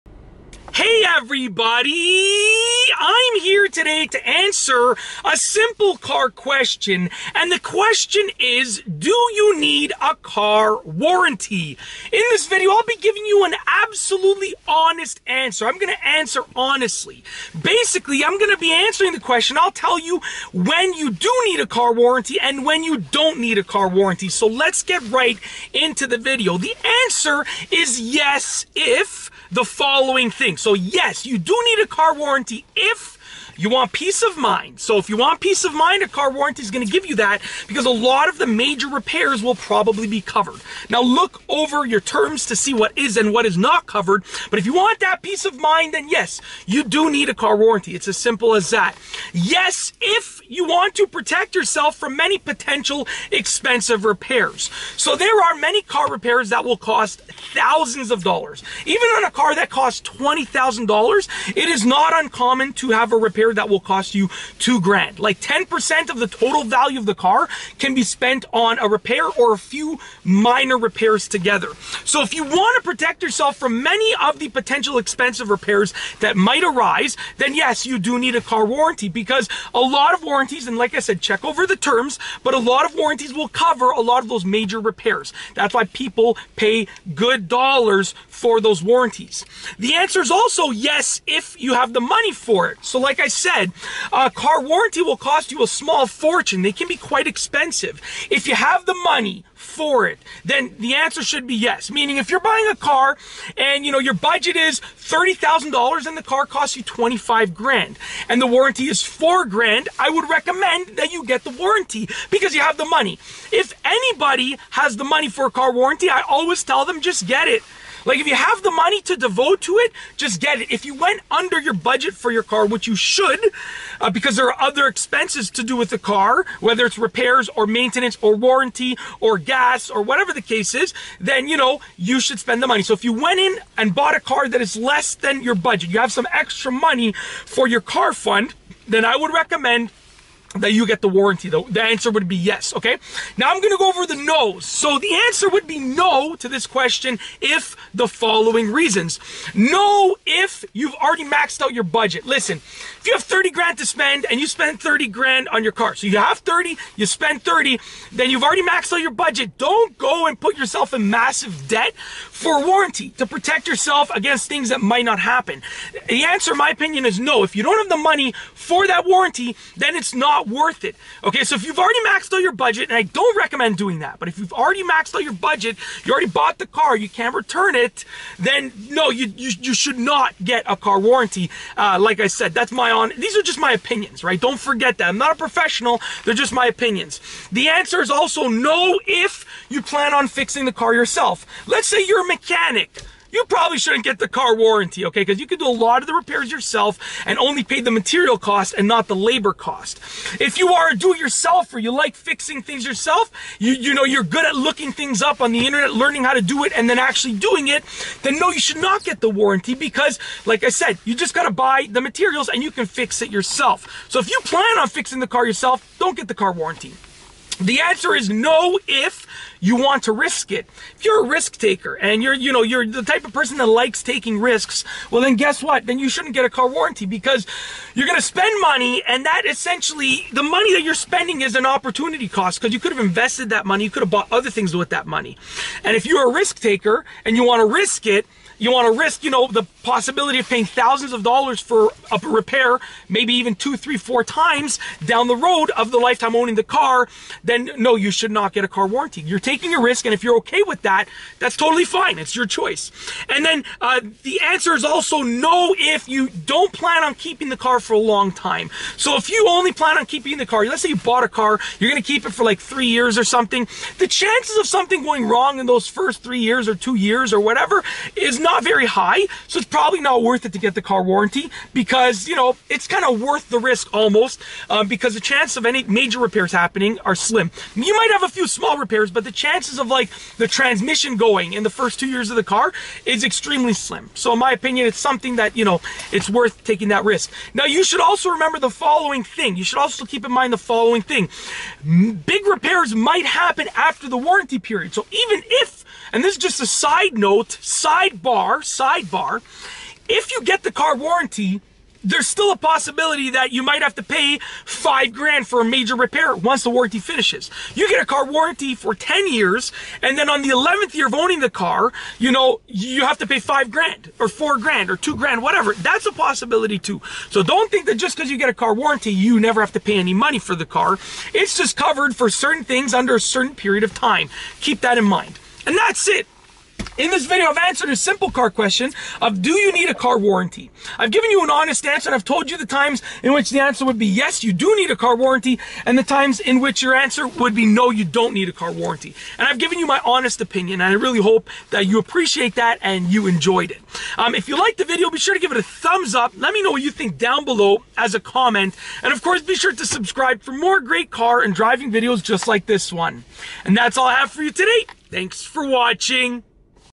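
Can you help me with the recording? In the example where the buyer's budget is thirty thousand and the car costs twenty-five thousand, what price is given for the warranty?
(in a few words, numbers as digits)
4 grand.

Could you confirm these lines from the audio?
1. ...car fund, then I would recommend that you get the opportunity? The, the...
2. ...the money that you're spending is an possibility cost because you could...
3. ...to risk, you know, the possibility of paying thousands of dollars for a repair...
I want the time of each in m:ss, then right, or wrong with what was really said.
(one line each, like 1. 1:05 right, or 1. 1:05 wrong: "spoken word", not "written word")
1. 2:17 wrong: "warranty", not "opportunity"
2. 3:50 wrong: "opportunity", not "possibility"
3. 3:58 right.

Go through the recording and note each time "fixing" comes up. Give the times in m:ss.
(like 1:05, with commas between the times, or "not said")
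3:10, 3:22, 3:34.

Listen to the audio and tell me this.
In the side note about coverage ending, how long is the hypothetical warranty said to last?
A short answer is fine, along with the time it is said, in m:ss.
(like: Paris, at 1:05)
10 years, at 5:08.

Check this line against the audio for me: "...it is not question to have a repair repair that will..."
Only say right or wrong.
wrong.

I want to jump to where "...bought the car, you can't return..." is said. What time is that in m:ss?
2:56.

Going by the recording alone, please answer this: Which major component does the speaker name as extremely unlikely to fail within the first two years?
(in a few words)
transmission.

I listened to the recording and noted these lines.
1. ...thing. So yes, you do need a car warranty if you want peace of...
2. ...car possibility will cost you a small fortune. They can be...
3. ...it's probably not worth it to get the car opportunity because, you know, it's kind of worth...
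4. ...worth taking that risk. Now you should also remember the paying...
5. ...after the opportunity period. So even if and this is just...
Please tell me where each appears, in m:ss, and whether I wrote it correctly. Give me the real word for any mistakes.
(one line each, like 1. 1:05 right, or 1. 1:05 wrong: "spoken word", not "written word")
1. 0:30 right
2. 1:34 wrong: "warranty", not "possibility"
3. 4:29 wrong: "warranty", not "opportunity"
4. 4:46 wrong: "following", not "paying"
5. 4:53 wrong: "warranty", not "opportunity".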